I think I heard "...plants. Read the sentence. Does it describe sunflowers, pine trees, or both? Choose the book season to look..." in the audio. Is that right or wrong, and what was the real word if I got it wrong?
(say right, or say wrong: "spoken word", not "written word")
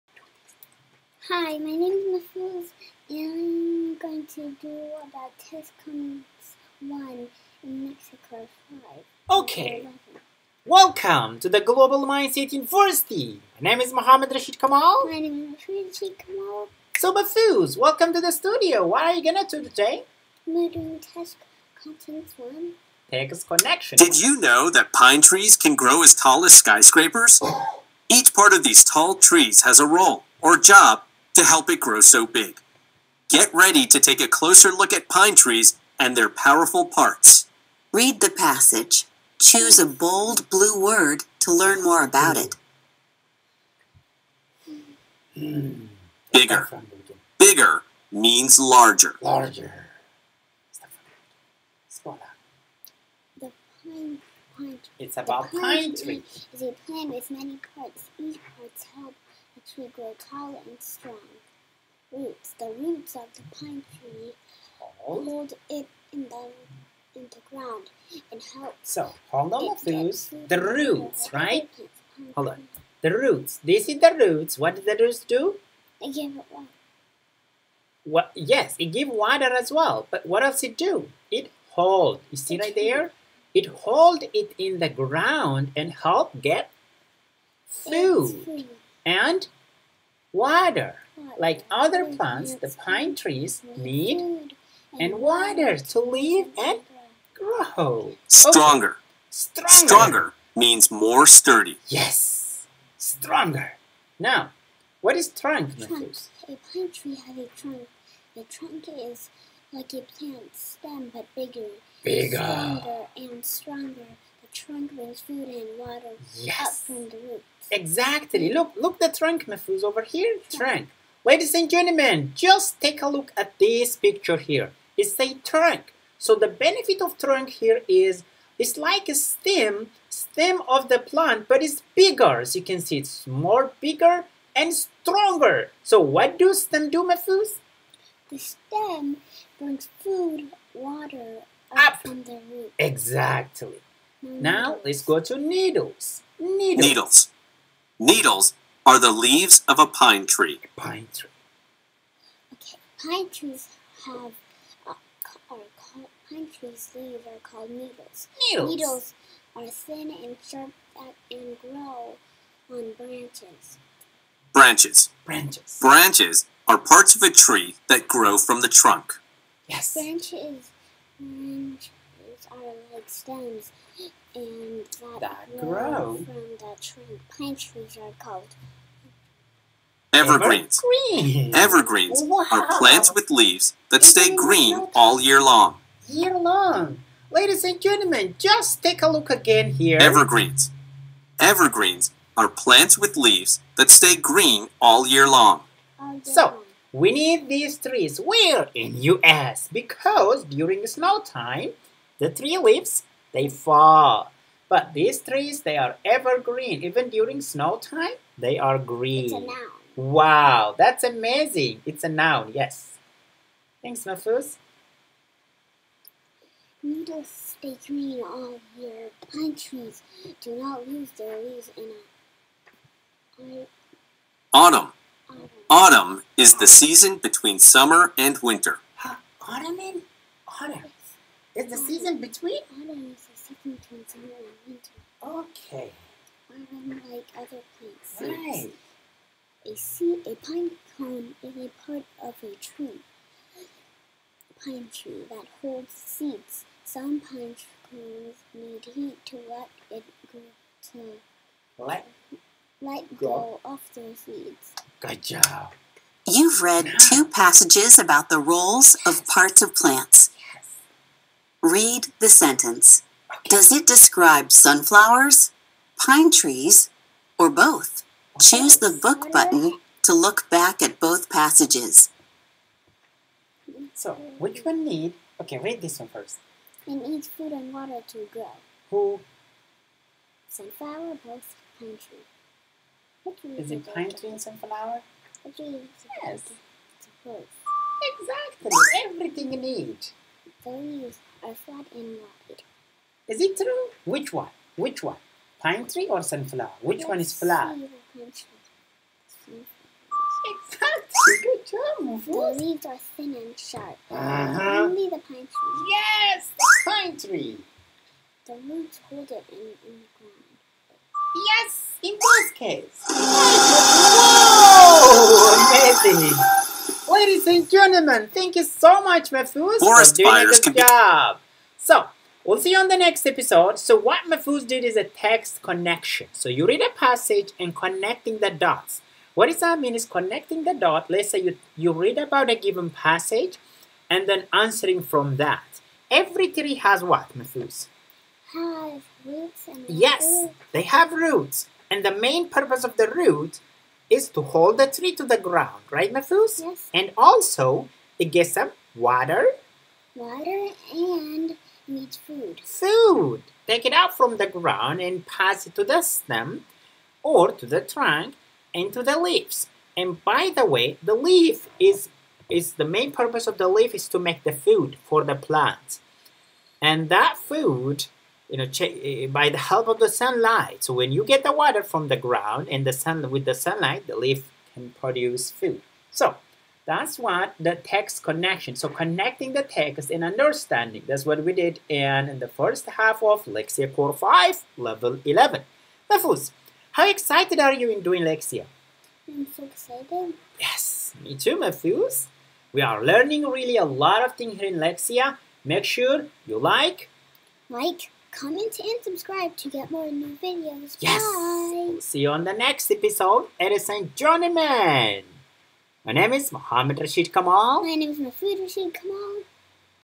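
wrong: "button", not "season".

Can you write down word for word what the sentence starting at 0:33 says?
Get ready to take a closer look at pine trees and their powerful parts.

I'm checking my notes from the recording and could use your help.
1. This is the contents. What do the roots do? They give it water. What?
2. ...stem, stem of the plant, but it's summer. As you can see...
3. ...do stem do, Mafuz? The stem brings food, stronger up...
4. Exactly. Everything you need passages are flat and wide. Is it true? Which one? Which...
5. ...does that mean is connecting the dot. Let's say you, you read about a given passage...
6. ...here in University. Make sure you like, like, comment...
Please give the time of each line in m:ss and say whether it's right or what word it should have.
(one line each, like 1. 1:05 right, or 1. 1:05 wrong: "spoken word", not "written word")
1. 1:13 wrong: "roots", not "contents"
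2. 2:09 wrong: "bigger", not "summer"
3. 2:16 wrong: "water", not "stronger"
4. 4:48 wrong: "leaves", not "passages"
5. 5:29 right
6. 6:34 wrong: "Lexia", not "University".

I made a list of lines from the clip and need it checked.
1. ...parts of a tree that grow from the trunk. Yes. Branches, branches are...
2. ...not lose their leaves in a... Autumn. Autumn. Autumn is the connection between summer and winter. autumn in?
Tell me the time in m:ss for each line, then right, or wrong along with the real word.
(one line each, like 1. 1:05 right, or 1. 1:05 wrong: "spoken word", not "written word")
1. 2:46 right
2. 3:40 wrong: "season", not "connection".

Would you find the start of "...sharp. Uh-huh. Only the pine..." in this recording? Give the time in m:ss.
5:03.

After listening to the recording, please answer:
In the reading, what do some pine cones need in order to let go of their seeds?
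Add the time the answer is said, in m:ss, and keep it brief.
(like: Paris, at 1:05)
Heat, at 4:06.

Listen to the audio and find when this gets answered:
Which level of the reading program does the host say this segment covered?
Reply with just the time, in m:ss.
6:24.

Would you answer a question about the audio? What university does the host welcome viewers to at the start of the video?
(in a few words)
Global Mindset University.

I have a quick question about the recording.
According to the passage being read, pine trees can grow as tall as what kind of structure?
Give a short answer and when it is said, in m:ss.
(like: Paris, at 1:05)
Skyscrapers, at 0:26.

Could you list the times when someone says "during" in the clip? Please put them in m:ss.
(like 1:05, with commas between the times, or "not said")
3:20, 3:27.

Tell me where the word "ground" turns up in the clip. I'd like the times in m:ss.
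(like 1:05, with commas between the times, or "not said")
1:07, 1:24, 5:10, 5:45, 5:54, 6:12.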